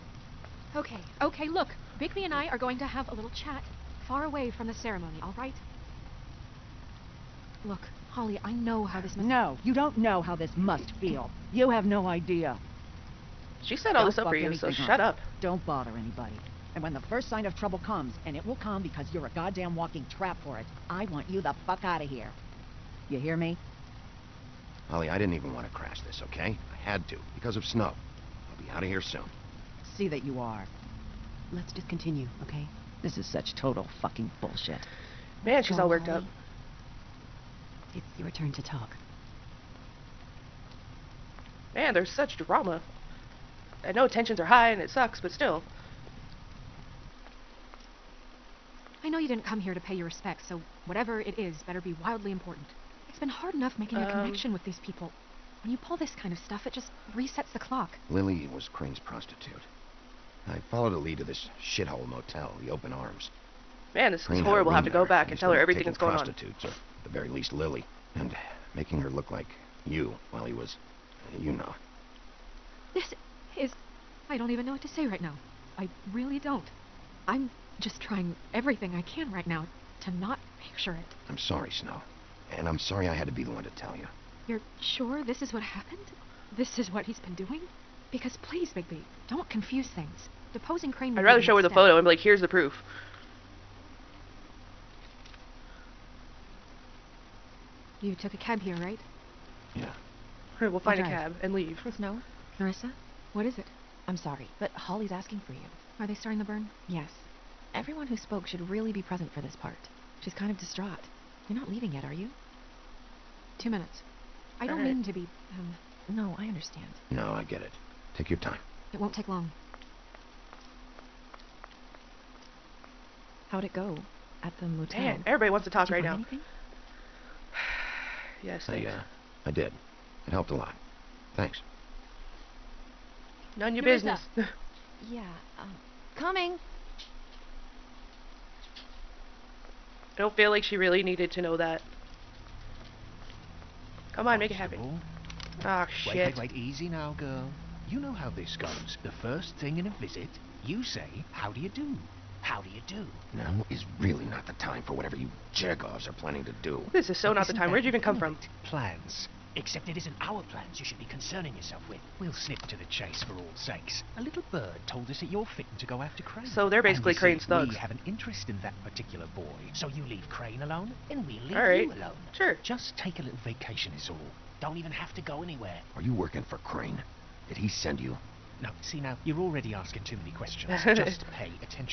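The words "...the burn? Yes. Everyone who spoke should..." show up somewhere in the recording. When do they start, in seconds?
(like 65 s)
106 s.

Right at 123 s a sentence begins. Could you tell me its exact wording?
How'd it go at the motel?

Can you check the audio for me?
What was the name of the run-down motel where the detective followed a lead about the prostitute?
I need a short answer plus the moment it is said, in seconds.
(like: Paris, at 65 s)
Open Arms, at 62 s.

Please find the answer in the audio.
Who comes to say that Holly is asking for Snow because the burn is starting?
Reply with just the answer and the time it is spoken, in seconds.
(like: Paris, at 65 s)
Nerissa, at 102 s.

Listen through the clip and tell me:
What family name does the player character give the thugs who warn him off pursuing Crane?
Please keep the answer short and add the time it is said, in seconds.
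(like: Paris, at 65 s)
Jergovs, at 155 s.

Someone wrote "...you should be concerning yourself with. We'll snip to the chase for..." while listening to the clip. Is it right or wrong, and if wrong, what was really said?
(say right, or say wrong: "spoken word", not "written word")
right.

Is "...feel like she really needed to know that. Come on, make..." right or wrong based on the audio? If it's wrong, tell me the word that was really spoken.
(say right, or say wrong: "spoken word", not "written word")
right.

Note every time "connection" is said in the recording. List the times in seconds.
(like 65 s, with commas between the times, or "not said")
54 s.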